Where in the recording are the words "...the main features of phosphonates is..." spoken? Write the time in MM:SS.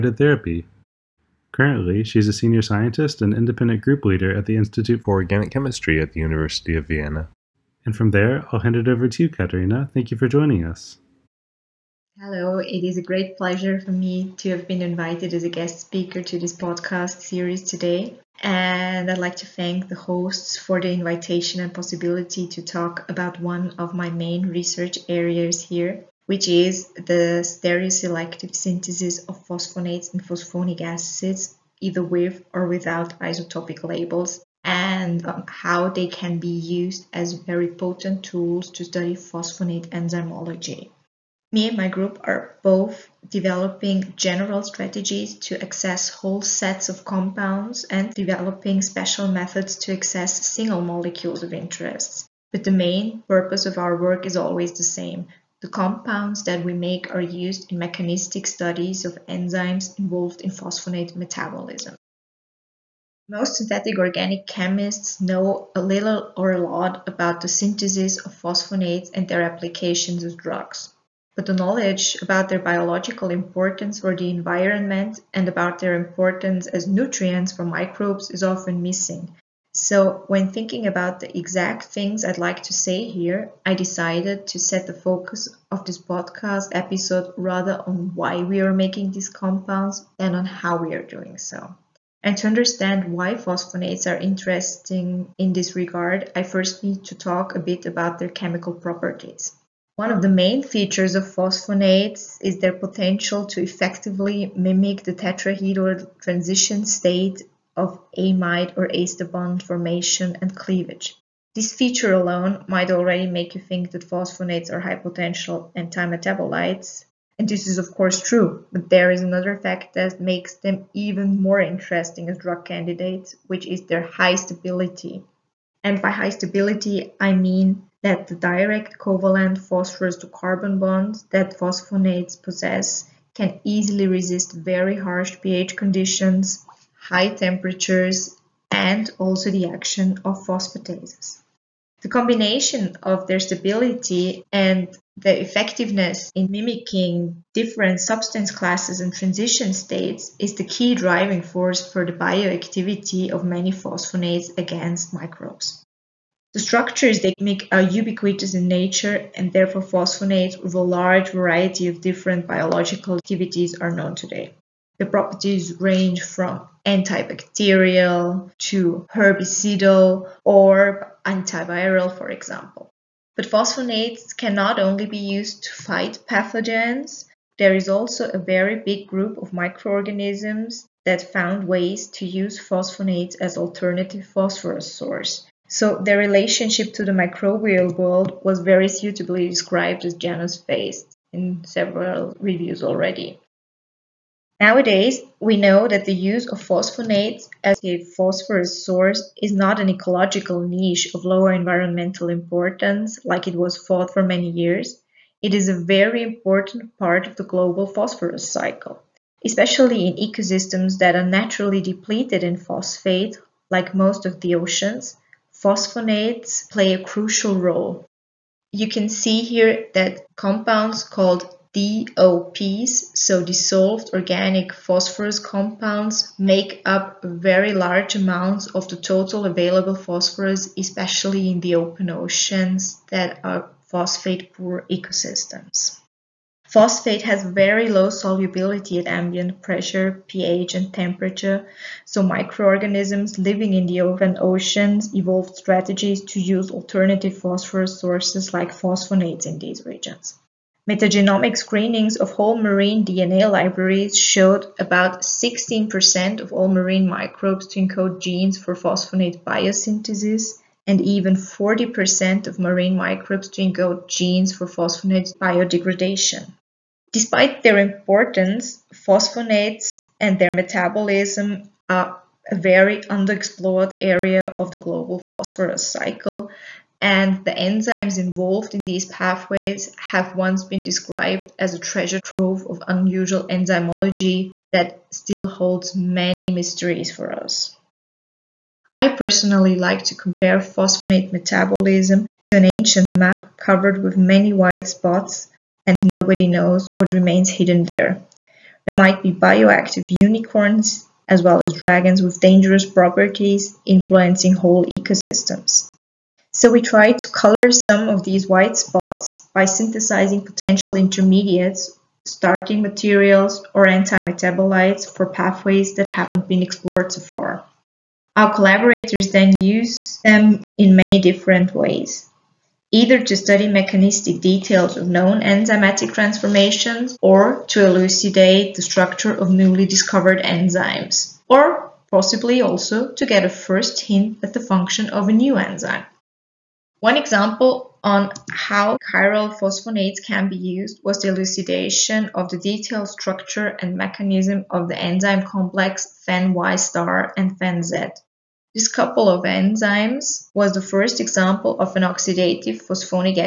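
01:40.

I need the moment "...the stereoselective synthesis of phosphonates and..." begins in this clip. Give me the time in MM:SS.
00:26.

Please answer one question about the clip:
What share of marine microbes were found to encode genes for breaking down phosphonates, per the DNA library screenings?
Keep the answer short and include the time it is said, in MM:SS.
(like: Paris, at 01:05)
40%, at 04:21.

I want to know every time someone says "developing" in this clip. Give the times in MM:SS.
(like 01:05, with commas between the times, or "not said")
00:43, 00:48.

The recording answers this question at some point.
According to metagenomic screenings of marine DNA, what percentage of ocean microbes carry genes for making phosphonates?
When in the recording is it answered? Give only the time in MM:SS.
04:15.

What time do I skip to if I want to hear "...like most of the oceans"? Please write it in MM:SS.
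03:33.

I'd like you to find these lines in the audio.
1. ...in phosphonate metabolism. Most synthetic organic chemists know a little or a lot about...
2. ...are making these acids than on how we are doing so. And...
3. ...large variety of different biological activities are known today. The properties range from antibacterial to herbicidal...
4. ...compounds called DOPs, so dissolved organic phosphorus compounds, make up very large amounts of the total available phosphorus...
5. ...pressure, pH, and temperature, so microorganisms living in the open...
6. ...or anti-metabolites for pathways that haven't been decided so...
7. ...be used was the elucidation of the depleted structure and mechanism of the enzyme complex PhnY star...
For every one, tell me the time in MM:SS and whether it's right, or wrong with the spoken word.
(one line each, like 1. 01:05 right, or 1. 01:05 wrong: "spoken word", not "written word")
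1. 01:00 right
2. 01:28 wrong: "compounds", not "acids"
3. 02:40 right
4. 03:40 right
5. 03:59 right
6. 05:13 wrong: "explored", not "decided"
7. 05:40 wrong: "detailed", not "depleted".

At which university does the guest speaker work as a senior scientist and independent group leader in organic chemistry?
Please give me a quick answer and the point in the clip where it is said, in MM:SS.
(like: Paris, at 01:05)
University of Vienna, at 00:06.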